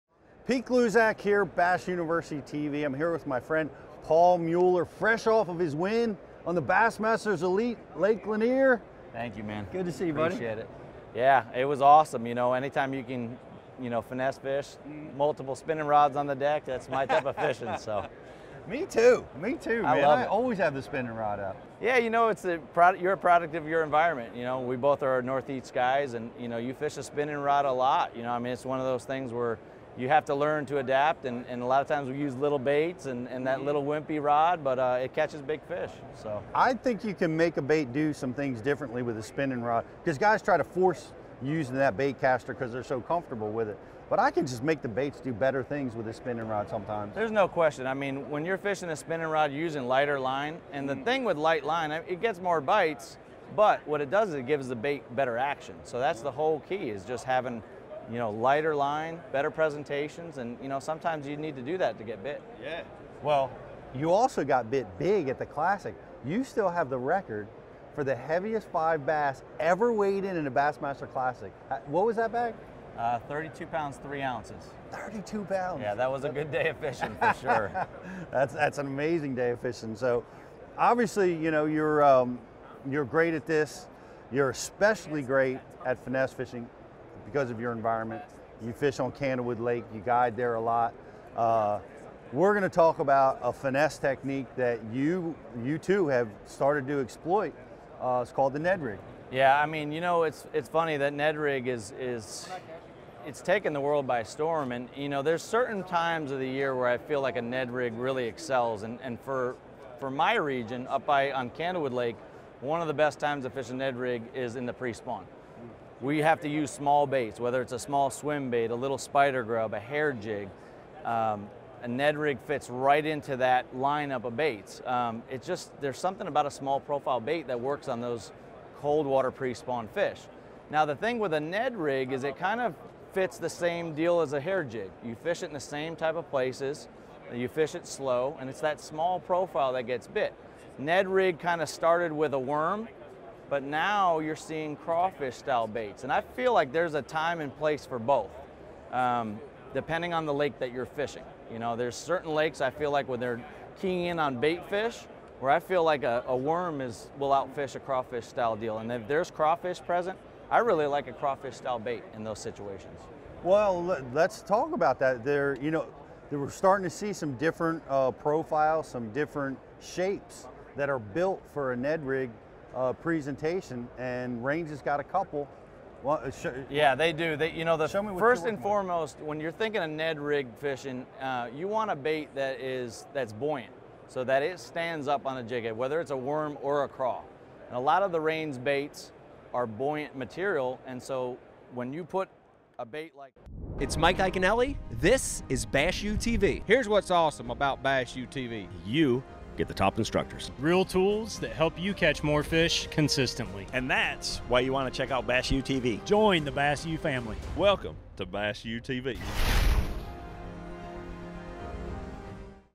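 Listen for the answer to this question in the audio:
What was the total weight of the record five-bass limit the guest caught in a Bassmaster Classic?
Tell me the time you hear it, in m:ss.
1:13.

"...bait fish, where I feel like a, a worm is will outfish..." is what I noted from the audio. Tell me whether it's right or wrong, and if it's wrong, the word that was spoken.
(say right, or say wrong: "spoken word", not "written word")
right.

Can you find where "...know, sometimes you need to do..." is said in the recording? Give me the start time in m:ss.
1:00.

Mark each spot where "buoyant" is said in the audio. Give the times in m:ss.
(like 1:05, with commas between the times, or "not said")
3:03, 3:09.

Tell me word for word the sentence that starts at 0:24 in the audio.
You know, we both are northeast guys, and you know, you fish a spinning rod a lot.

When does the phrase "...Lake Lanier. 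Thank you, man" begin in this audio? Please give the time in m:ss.
0:07.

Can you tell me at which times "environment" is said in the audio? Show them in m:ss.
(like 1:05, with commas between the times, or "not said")
0:23, 1:27.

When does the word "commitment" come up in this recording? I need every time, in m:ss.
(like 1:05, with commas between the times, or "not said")
not said.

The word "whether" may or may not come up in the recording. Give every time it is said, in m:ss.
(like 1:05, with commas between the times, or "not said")
1:57, 3:05.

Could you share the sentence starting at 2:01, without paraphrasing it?
Um, a Ned rig fits right into that lineup of baits.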